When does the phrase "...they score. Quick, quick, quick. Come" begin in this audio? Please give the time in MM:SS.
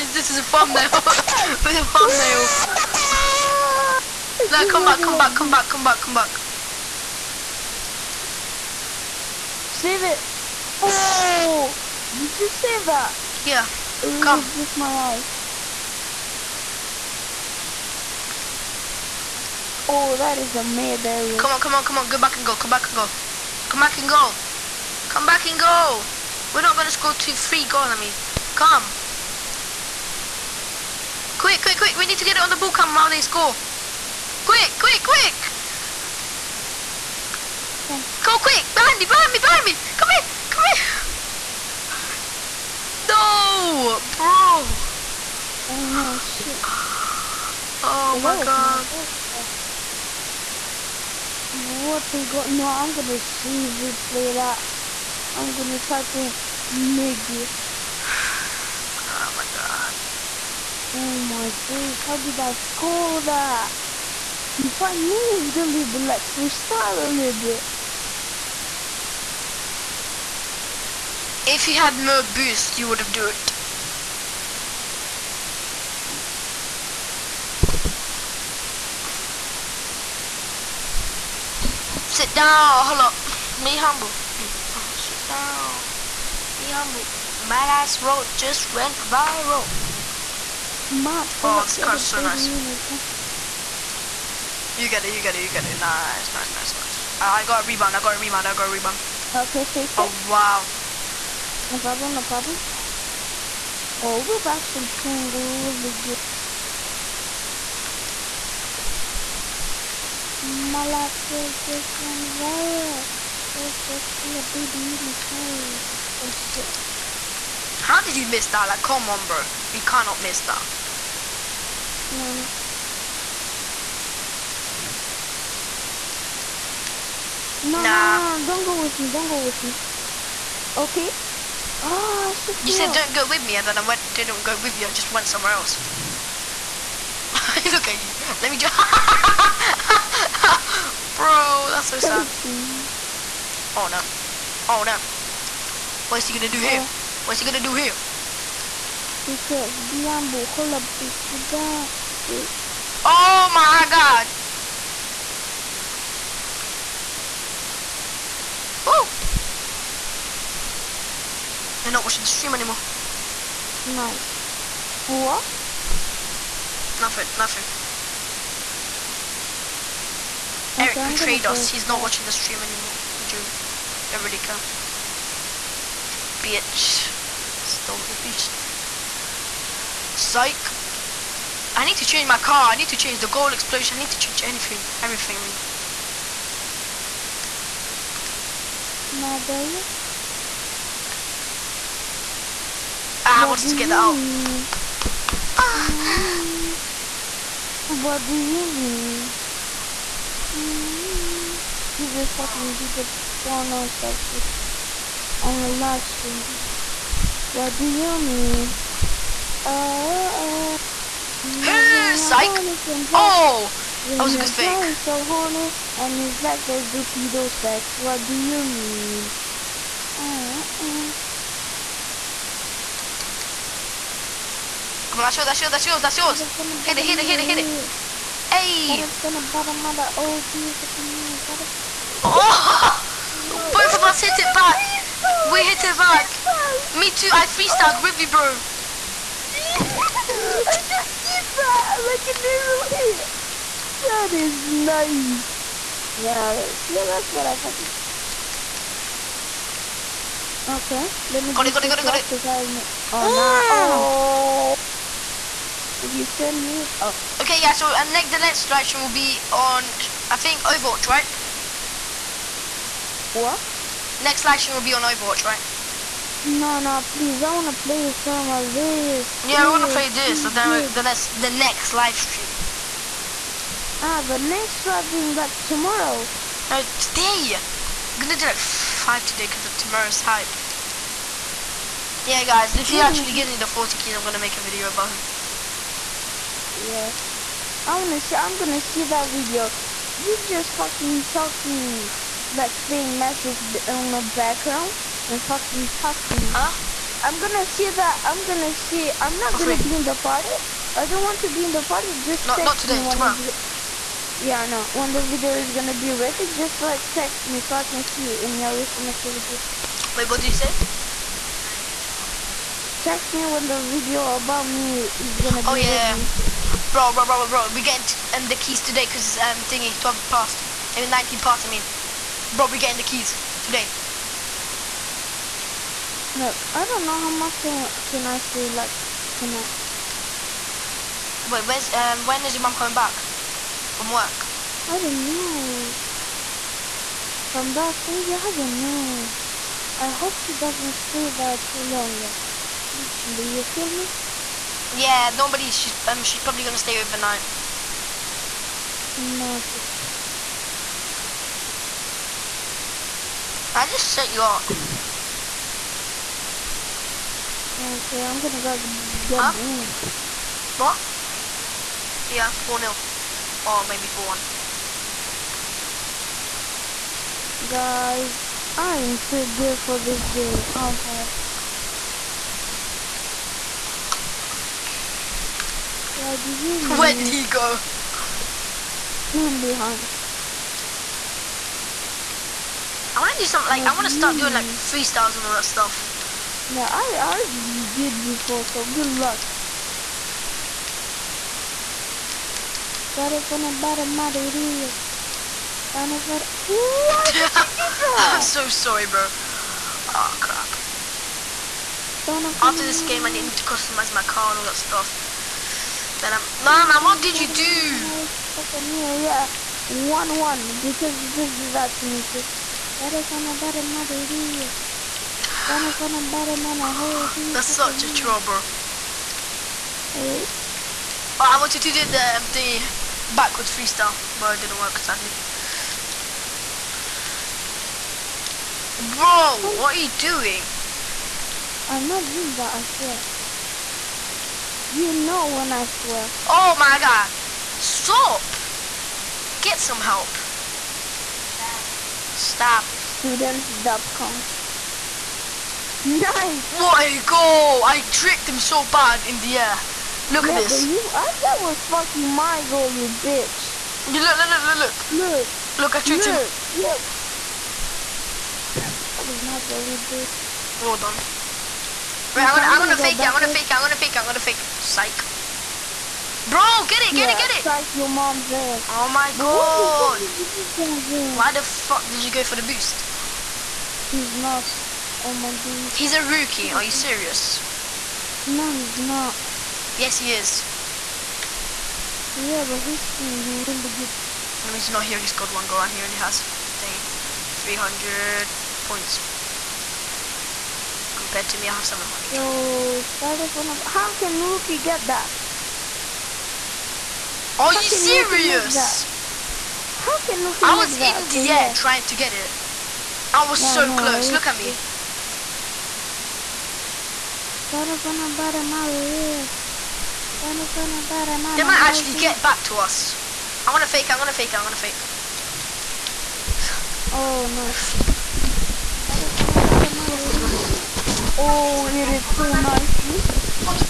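00:33.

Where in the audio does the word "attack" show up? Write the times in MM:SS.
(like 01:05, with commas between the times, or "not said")
not said.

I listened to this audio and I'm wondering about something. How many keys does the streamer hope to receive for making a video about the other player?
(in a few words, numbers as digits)
40.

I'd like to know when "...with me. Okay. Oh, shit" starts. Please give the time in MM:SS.
02:09.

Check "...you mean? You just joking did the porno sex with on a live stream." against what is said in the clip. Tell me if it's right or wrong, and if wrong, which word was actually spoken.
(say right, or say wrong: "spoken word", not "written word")
wrong: "fucking", not "joking".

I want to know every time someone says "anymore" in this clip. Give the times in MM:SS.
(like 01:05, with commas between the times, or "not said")
02:42, 02:52.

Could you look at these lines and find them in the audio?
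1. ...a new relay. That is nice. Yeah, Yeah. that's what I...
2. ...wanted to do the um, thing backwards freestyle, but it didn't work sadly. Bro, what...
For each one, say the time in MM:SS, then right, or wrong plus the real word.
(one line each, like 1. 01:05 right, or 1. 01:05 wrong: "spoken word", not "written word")
1. 04:02 right
2. 07:01 right.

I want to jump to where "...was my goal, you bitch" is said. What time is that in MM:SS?
07:39.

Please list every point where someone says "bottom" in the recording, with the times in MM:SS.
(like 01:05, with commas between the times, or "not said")
06:33.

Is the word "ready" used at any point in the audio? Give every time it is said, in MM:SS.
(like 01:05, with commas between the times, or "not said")
05:06, 05:16.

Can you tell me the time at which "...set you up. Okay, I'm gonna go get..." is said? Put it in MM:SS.
05:54.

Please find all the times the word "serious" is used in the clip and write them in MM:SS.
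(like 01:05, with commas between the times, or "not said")
07:56, 08:17.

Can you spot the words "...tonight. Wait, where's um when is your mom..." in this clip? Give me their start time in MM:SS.
05:29.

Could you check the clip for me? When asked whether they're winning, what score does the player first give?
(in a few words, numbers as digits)
4-0.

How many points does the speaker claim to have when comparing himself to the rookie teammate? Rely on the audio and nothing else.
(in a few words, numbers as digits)
700.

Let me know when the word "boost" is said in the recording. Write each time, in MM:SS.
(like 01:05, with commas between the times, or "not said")
01:12, 07:52.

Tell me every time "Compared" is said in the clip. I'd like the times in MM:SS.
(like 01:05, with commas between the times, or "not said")
08:11.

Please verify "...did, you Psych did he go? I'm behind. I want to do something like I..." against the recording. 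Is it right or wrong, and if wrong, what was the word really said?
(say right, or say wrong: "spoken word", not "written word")
wrong: "Where", not "Psych".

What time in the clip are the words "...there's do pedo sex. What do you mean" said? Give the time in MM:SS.
03:36.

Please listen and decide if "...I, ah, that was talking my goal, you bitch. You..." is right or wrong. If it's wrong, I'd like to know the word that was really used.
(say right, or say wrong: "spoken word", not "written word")
wrong: "fucking", not "talking".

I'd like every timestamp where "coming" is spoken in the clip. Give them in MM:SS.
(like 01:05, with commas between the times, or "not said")
05:32.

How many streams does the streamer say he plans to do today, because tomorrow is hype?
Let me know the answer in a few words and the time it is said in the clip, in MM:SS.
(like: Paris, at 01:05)
5, at 04:38.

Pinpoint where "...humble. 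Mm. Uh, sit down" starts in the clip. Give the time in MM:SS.
01:23.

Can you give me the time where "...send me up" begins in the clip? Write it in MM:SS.
04:16.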